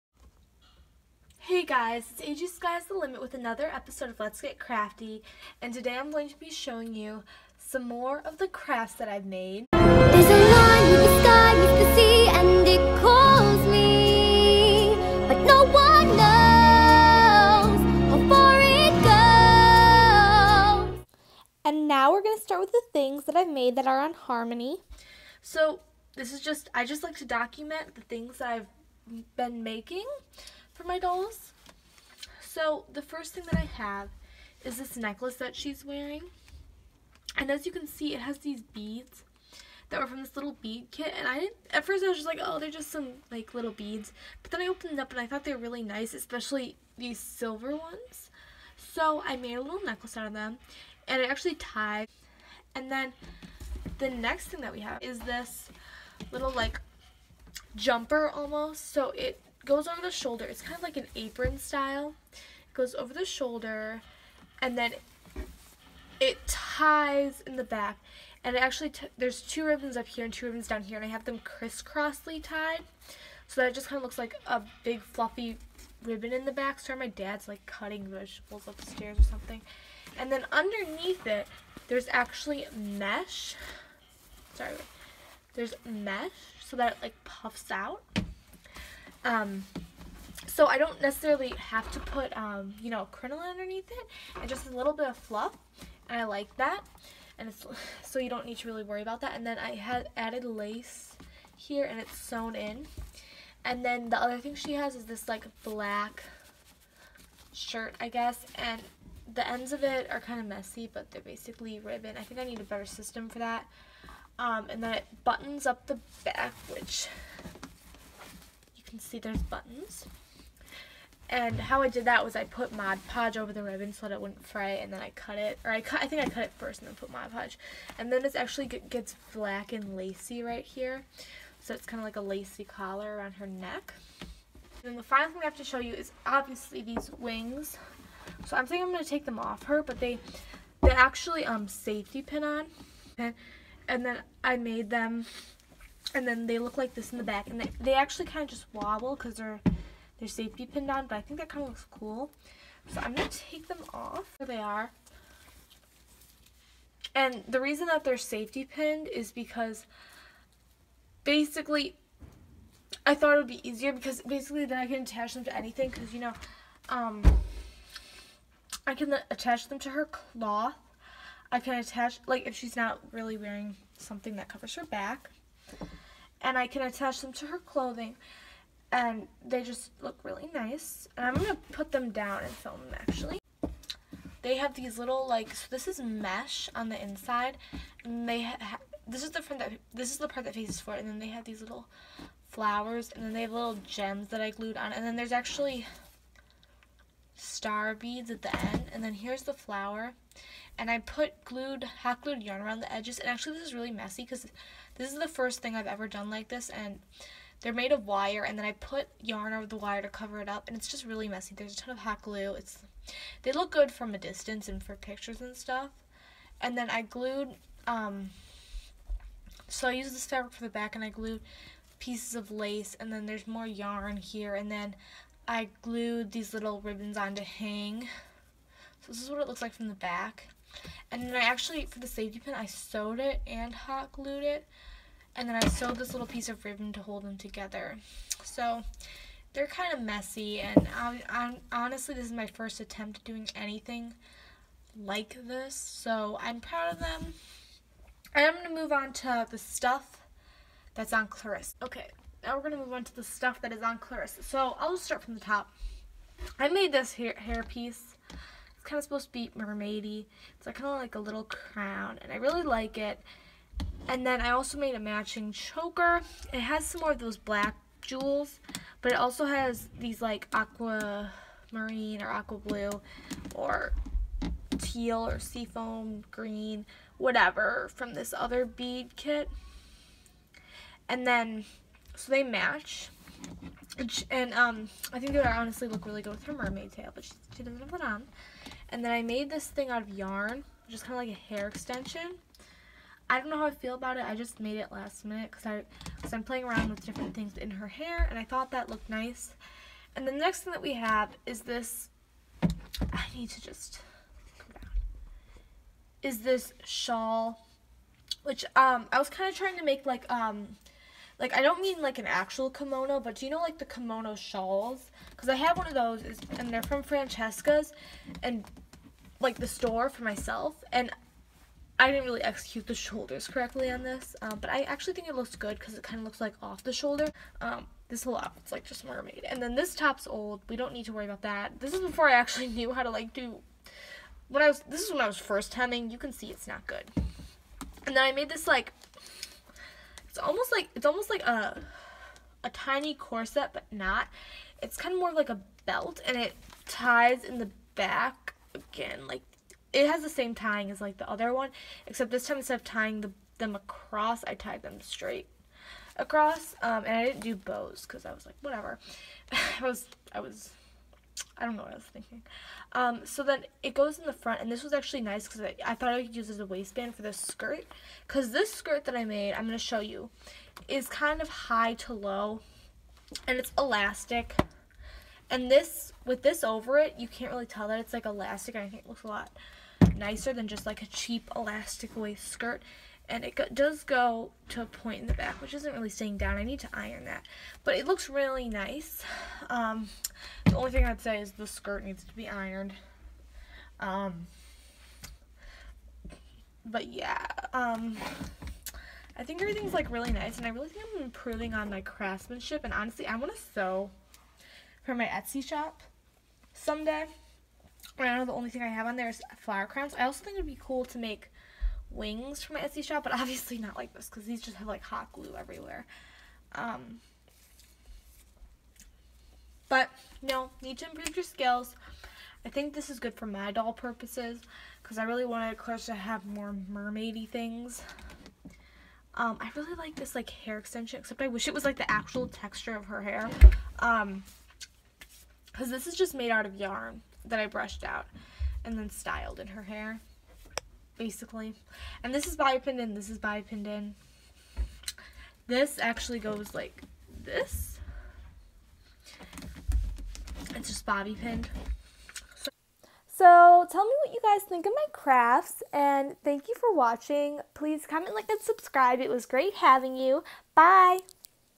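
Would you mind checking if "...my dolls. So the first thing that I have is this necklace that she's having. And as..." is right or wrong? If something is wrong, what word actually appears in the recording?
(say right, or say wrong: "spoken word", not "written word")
wrong: "wearing", not "having".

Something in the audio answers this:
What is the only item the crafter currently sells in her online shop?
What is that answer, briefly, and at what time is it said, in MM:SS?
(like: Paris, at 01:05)
flower crowns, at 06:49.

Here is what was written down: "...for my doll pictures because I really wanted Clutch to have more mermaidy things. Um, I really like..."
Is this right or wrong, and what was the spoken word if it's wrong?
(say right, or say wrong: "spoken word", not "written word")
wrong: "purposes", not "pictures".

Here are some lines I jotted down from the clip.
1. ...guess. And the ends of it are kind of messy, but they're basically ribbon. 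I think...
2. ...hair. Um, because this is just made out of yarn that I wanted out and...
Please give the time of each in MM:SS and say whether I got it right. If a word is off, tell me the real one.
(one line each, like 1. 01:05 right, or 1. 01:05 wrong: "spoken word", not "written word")
1. 01:48 right
2. 07:13 wrong: "brushed", not "wanted".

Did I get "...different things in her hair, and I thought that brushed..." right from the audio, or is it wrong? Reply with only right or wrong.
wrong.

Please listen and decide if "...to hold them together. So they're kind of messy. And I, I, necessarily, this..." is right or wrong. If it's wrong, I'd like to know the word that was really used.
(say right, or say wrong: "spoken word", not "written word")
wrong: "honestly", not "necessarily".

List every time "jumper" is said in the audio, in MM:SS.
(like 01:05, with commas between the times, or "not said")
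00:57.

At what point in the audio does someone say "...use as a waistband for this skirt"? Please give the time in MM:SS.
06:06.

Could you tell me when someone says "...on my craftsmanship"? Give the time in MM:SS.
06:41.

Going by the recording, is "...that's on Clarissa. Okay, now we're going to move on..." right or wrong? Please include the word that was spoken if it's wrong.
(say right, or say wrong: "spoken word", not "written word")
right.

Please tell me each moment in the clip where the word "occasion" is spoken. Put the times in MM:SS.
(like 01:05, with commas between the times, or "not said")
not said.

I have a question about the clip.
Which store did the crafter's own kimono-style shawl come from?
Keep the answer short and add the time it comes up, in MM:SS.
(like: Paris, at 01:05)
Francesca's, at 05:17.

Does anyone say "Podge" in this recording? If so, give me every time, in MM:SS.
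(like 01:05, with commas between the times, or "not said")
02:03, 02:07.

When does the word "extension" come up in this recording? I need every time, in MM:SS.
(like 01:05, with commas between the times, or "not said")
04:51, 07:10.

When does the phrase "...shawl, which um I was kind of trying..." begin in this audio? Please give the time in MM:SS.
05:06.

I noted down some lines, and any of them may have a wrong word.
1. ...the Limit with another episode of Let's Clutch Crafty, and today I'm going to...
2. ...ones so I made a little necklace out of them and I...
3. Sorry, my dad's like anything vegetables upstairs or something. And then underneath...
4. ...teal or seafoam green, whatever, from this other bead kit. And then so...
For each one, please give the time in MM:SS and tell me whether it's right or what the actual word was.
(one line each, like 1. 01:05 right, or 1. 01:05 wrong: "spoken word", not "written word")
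1. 00:02 wrong: "Get", not "Clutch"
2. 00:47 right
3. 01:16 wrong: "cutting", not "anything"
4. 04:34 right.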